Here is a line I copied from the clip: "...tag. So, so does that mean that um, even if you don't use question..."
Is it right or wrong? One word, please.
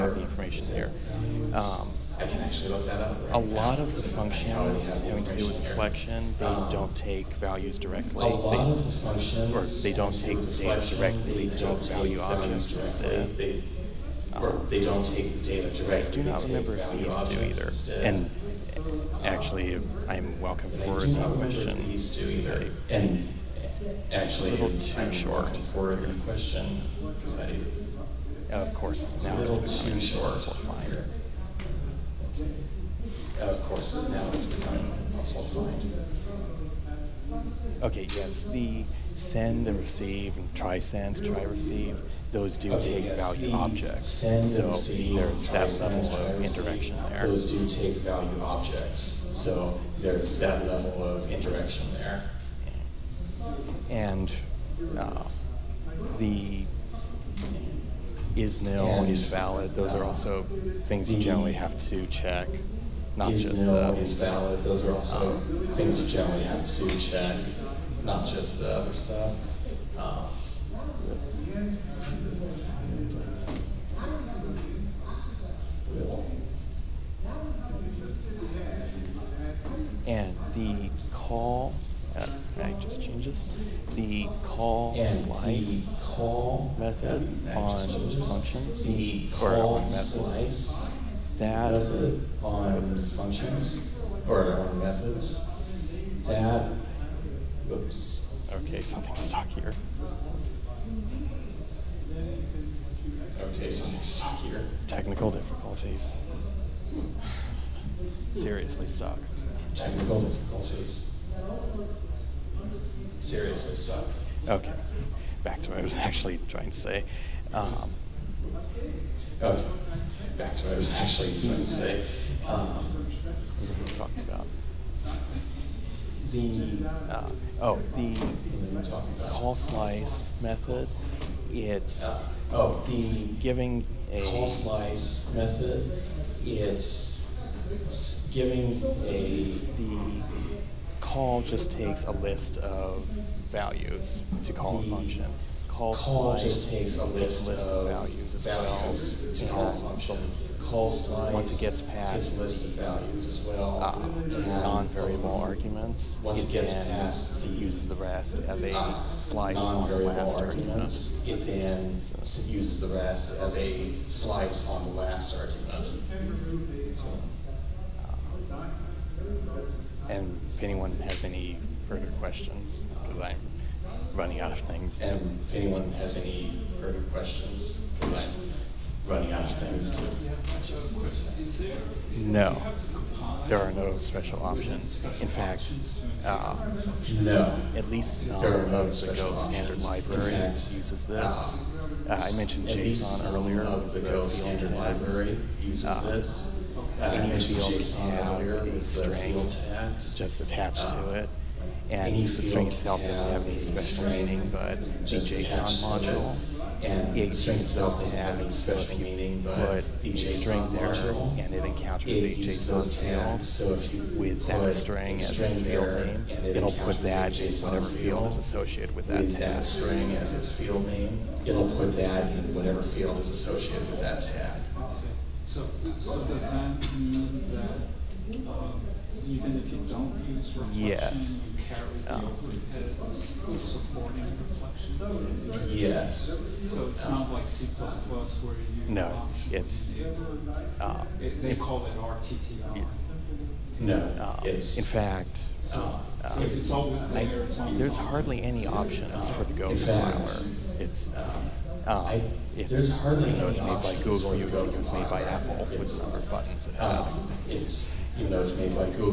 wrong.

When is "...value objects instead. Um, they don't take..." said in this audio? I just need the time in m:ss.
0:11.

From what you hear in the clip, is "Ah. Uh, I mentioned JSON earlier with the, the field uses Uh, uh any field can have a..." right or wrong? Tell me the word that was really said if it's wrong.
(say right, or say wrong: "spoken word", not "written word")
right.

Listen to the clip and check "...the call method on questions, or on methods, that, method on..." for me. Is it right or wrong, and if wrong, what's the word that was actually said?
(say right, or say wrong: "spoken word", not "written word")
wrong: "functions", not "questions".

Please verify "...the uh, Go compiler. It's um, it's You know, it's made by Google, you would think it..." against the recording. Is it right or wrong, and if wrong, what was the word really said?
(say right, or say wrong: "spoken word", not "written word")
right.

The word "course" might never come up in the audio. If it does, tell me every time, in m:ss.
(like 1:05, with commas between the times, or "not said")
0:28, 0:33.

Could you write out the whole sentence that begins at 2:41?
It then uses the rest as a slice on the last argument.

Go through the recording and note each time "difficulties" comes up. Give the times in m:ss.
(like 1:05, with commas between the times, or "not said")
1:45, 1:50.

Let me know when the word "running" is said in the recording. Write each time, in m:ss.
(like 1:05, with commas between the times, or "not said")
2:54, 2:59.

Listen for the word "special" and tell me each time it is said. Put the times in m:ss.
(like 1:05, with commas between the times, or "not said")
3:03, 3:23, 3:28.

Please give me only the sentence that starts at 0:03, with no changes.
Right a lot now, of the functions having to do with reflection, they um, don't take values directly.